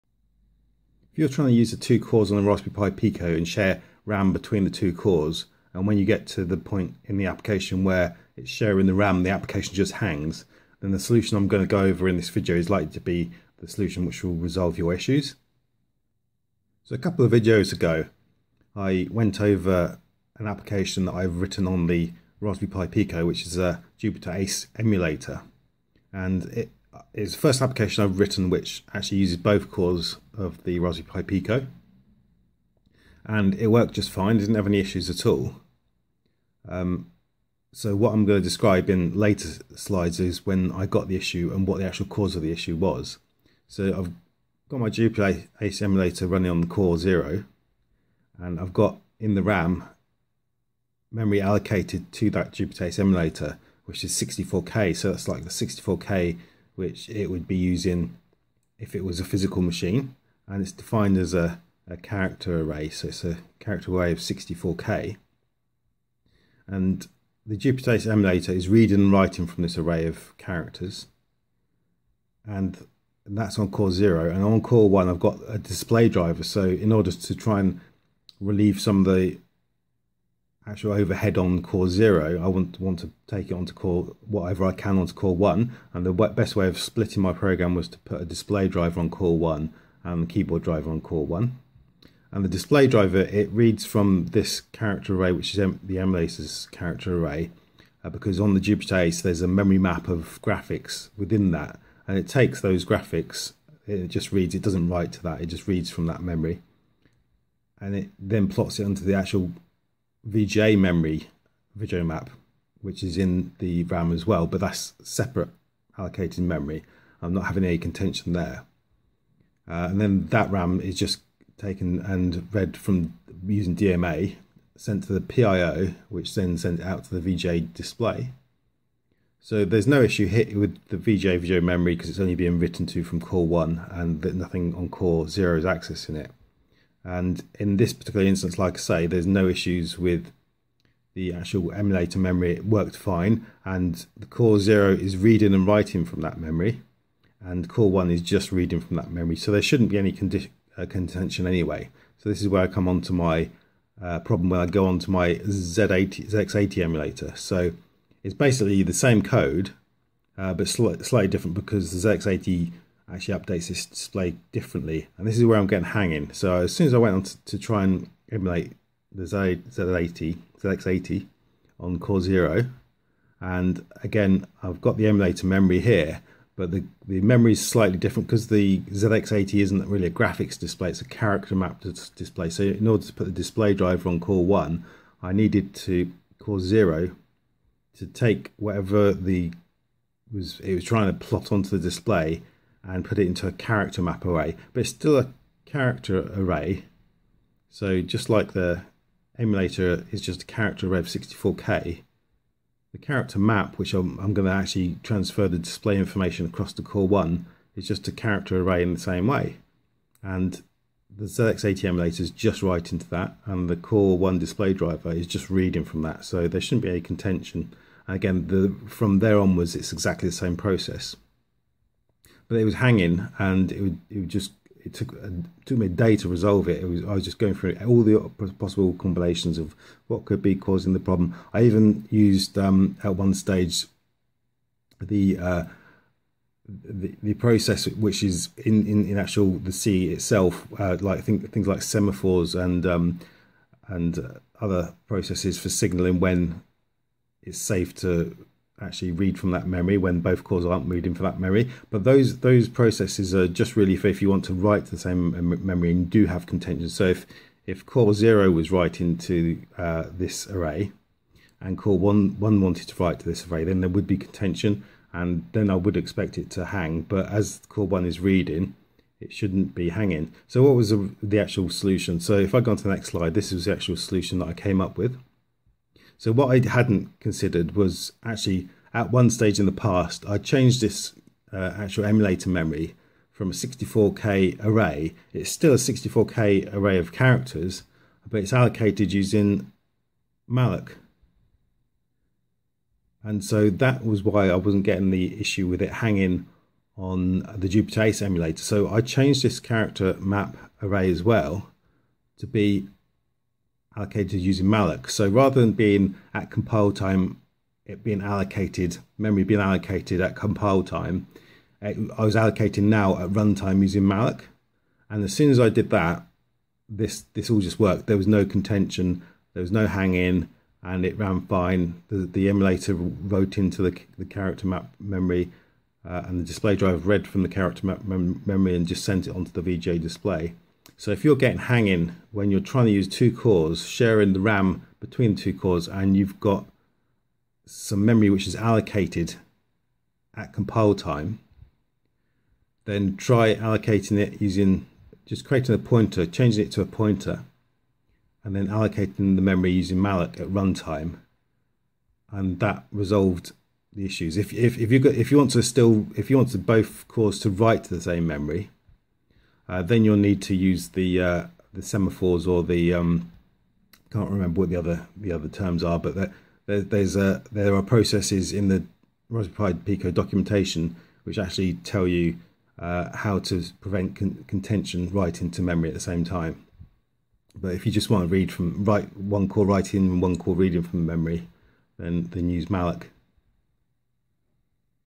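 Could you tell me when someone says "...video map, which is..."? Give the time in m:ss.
1:51.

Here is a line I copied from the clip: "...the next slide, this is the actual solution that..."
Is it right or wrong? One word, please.
right.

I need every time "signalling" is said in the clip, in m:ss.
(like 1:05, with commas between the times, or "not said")
4:05.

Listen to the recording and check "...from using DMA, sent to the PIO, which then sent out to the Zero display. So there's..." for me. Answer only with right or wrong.
wrong.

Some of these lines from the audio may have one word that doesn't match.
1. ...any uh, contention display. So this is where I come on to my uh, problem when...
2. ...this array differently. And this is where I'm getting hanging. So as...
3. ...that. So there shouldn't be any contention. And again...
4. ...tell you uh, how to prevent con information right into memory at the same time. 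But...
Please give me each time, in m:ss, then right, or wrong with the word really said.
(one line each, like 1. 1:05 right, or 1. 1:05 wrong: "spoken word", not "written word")
1. 2:29 wrong: "anyway", not "display"
2. 2:43 wrong: "display", not "array"
3. 3:36 right
4. 6:11 wrong: "contention", not "information".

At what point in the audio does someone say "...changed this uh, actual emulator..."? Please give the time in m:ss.
4:40.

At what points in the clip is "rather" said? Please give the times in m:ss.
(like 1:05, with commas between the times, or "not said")
5:05.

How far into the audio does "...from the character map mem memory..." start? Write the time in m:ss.
5:27.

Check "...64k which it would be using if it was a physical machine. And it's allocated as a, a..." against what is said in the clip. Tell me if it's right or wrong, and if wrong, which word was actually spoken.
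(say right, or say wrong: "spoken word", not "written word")
wrong: "defined", not "allocated".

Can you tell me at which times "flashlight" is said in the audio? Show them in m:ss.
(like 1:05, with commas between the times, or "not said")
not said.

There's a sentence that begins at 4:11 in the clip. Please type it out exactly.
But those those processes are just really for if you want to write to the same memory and do have contention.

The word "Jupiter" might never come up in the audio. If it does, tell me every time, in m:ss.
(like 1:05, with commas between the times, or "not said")
0:23, 0:44, 0:52, 1:07, 1:38, 4:57.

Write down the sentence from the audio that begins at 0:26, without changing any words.
And it uh, is the first application I've written which actually uses both cores of the Raspberry Pi Pico.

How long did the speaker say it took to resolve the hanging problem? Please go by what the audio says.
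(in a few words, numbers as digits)
A day.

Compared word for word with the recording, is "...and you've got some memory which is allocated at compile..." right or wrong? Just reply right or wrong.
right.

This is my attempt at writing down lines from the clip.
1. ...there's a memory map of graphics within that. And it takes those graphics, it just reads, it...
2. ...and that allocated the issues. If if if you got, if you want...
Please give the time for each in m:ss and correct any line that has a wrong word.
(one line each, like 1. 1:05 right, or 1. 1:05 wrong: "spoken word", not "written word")
1. 1:39 right
2. 5:52 wrong: "resolved", not "allocated".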